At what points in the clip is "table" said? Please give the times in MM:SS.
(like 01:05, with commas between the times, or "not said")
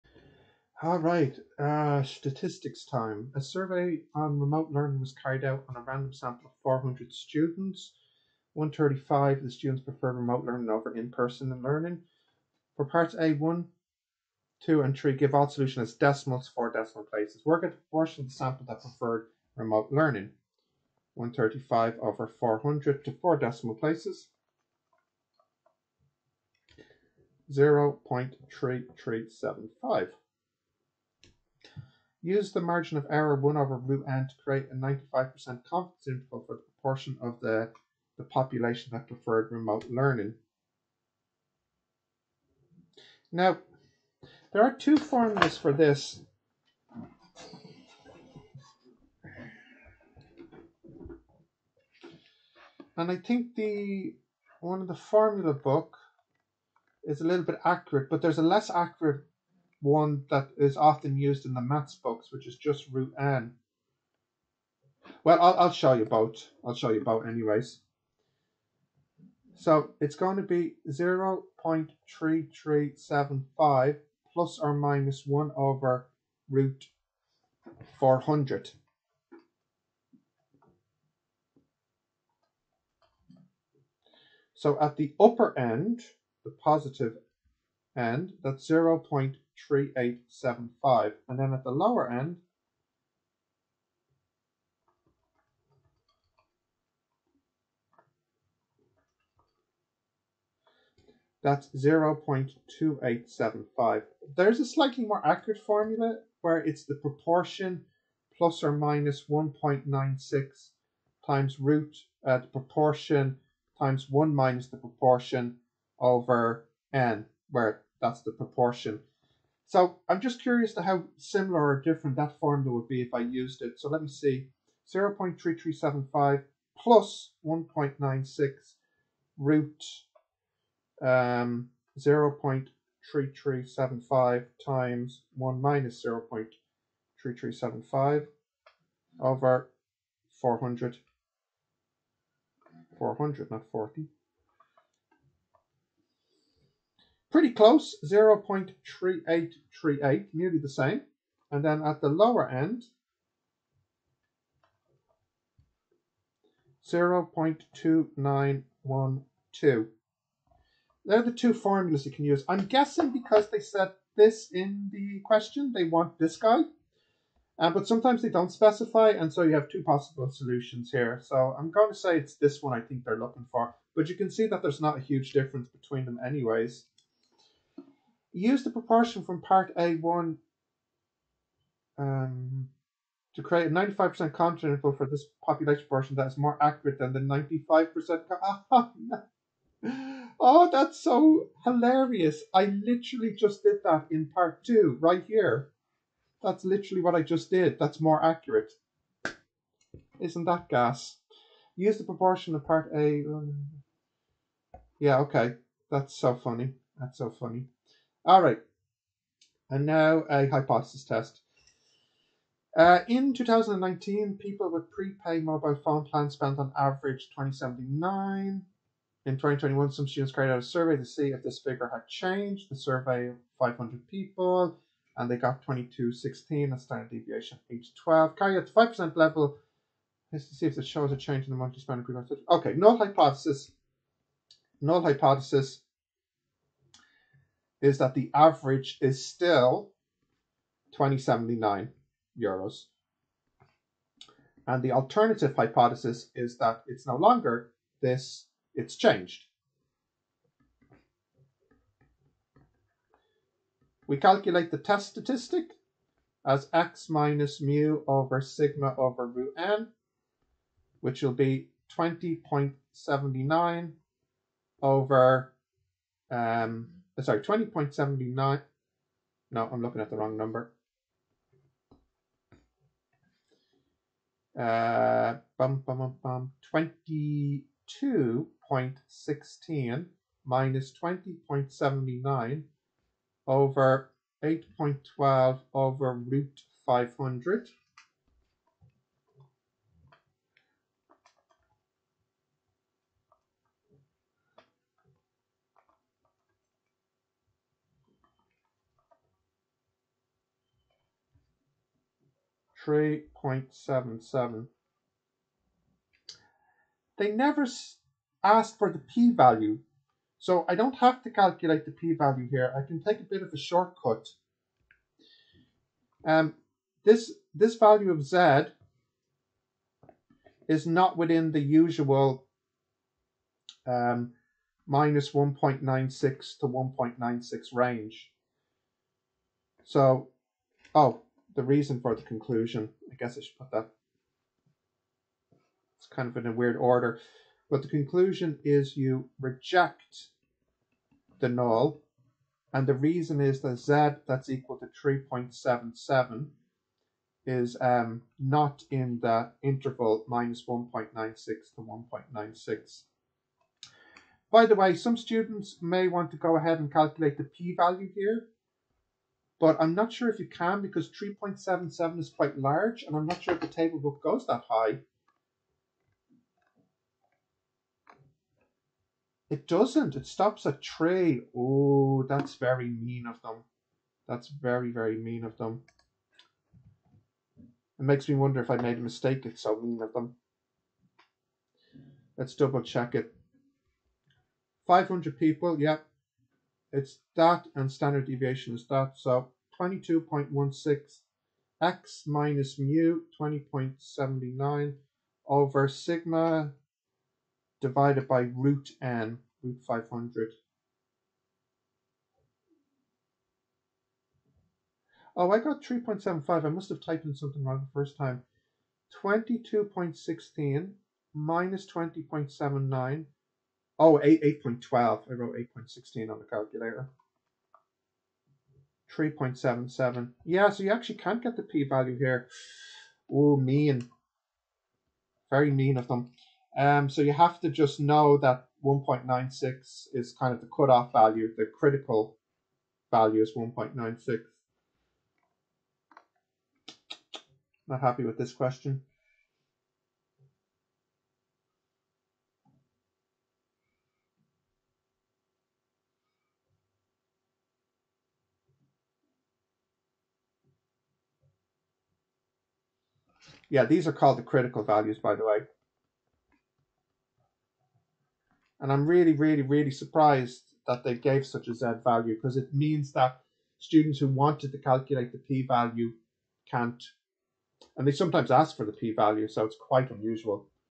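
06:03.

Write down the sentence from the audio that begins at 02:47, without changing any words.
Uh, but sometimes they don't specify, and so you have two possible solutions here.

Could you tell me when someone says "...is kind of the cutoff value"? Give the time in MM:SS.
07:10.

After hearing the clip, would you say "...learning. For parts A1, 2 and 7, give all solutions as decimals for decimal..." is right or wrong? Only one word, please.
wrong.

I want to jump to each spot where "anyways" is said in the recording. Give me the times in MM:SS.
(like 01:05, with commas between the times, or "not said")
01:07, 02:56.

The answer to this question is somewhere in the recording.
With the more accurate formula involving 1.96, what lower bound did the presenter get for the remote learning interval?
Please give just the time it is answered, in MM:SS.
02:36.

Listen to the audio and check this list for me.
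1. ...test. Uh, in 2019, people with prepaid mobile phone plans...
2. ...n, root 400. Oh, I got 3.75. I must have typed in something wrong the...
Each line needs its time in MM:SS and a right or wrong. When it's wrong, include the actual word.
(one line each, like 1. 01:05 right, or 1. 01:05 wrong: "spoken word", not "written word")
1. 03:31 right
2. 06:39 wrong: "500", not "400".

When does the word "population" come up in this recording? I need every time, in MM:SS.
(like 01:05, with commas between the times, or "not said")
00:38, 03:05.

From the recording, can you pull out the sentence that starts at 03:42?
The survey of 500 people, and they got 2216, a standard deviation age 12.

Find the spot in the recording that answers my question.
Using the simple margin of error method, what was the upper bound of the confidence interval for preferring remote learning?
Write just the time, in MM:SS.
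01:28.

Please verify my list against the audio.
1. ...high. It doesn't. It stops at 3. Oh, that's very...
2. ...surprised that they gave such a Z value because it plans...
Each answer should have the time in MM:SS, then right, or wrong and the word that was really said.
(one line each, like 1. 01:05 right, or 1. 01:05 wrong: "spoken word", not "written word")
1. 06:04 right
2. 07:39 wrong: "means", not "plans".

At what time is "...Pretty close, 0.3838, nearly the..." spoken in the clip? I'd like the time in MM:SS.
02:27.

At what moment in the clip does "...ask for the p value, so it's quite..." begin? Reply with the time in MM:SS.
07:48.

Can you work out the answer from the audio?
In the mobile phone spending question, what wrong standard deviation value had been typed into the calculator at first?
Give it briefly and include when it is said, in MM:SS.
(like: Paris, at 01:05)
8.16, at 06:55.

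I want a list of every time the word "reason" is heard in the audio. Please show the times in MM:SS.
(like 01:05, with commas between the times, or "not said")
05:31, 05:42.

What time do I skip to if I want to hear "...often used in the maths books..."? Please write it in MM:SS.
01:00.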